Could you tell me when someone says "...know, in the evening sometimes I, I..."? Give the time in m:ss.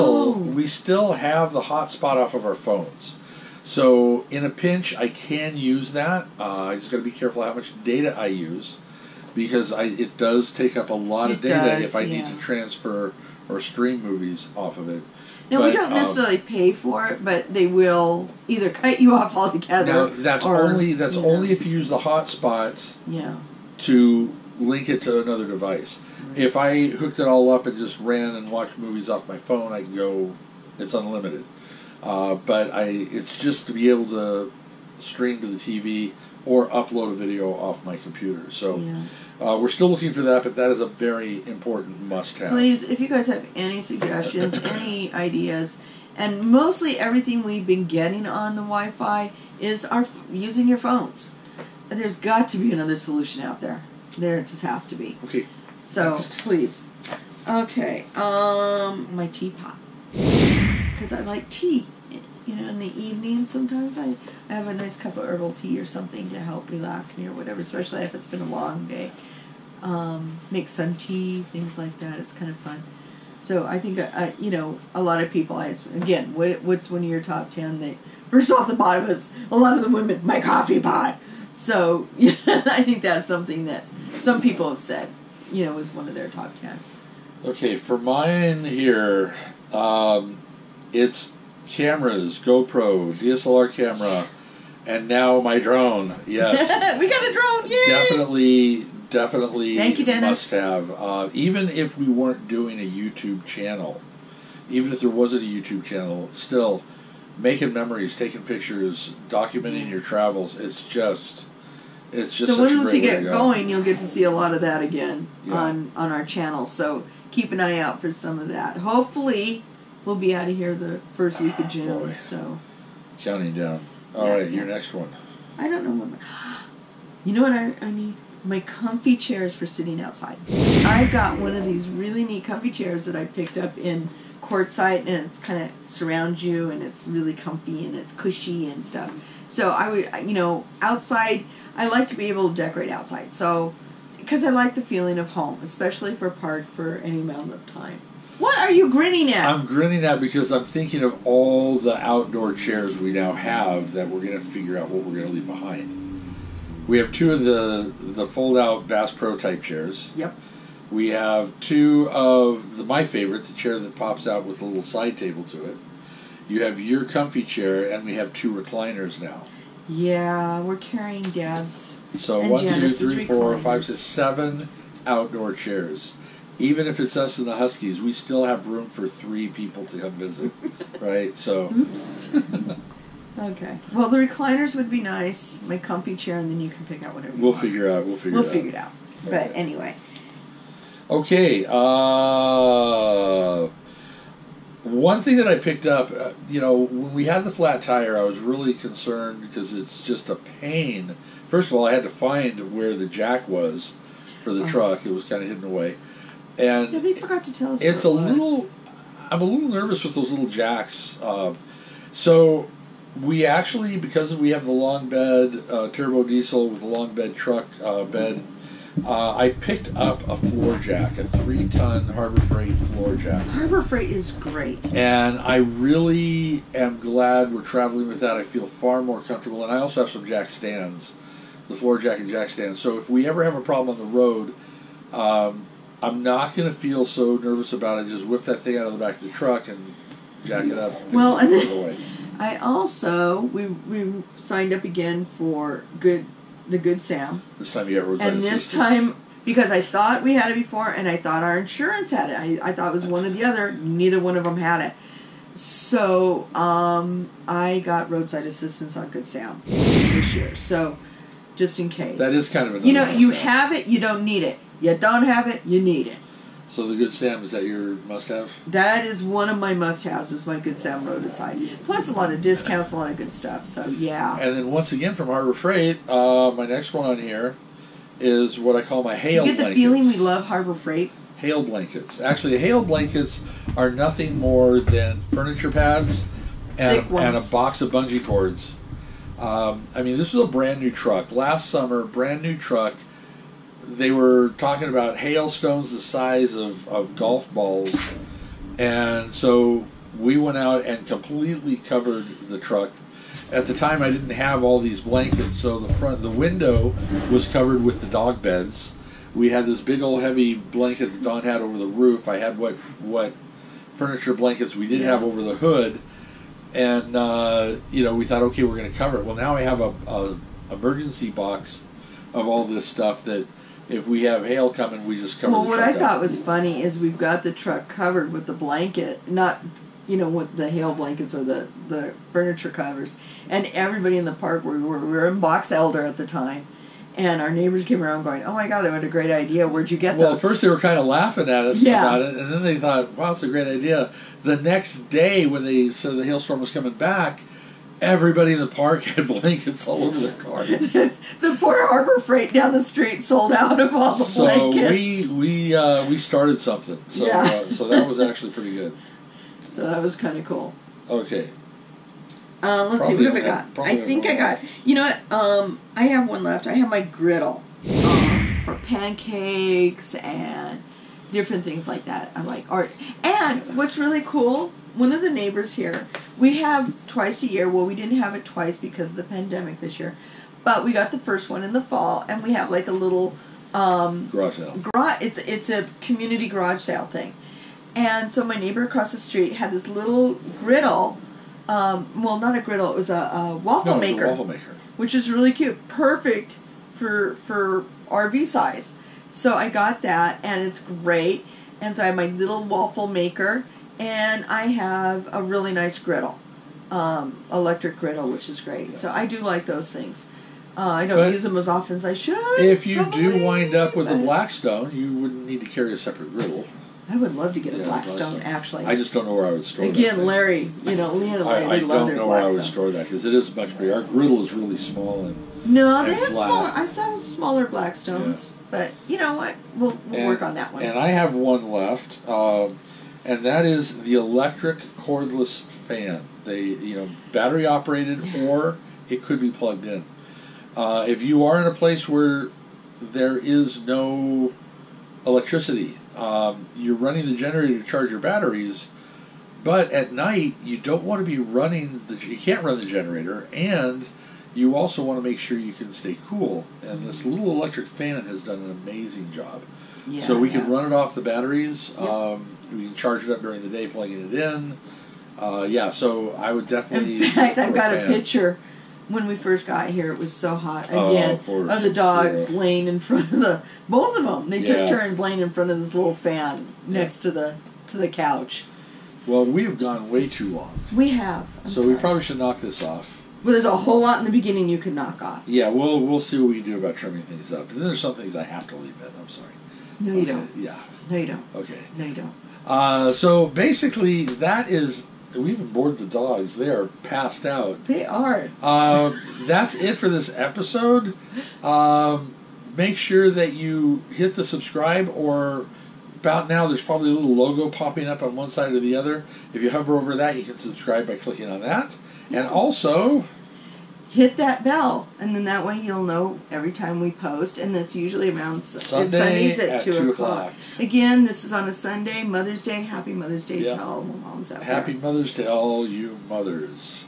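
1:02.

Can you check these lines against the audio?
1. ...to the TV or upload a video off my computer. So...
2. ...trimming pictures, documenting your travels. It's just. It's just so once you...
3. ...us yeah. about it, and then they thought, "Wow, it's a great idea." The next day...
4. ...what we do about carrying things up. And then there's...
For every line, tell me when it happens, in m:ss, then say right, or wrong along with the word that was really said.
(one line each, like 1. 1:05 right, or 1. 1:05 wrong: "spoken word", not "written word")
1. 0:35 right
2. 1:48 wrong: "taking", not "trimming"
3. 5:41 right
4. 8:06 wrong: "trimming", not "carrying".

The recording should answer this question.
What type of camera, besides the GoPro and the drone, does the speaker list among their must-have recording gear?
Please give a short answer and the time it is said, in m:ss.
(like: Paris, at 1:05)
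DSLR camera, at 1:33.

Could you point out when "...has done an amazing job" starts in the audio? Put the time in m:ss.
7:38.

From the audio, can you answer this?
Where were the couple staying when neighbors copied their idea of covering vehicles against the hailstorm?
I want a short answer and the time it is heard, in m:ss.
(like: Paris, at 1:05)
Box Elder, at 5:35.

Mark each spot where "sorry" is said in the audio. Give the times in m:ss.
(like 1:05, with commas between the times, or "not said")
8:01, 8:09.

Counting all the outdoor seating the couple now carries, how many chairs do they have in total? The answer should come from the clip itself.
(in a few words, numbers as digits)
7.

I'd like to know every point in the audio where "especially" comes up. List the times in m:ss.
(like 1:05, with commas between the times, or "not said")
1:07, 2:25.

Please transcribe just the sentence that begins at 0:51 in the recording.
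There's got to be another solution out there.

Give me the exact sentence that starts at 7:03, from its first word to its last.
Our griddle is really small and no, they had flat.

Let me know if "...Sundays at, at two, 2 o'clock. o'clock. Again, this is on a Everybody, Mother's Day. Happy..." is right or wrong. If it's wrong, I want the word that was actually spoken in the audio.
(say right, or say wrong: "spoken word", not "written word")
wrong: "Sunday", not "Everybody".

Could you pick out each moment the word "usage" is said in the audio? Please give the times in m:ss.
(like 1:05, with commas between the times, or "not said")
not said.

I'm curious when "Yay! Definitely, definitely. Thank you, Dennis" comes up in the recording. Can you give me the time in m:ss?
1:37.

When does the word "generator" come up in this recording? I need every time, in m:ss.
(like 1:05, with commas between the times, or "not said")
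7:27, 7:32.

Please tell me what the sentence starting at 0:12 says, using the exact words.
need to transfer or stream movies off of it.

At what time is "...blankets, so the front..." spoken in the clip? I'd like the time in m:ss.
5:05.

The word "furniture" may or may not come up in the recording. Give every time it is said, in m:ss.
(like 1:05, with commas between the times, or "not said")
4:45, 5:13, 5:32.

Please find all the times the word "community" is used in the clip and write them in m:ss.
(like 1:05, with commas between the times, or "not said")
6:25.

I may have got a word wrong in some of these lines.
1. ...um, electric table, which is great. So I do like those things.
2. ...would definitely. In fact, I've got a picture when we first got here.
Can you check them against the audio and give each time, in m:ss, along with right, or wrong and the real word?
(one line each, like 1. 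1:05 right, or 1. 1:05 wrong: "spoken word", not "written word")
1. 6:46 wrong: "griddle", not "table"
2. 7:46 right.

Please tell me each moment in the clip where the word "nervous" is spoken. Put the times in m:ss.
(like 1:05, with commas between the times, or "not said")
3:29, 3:57.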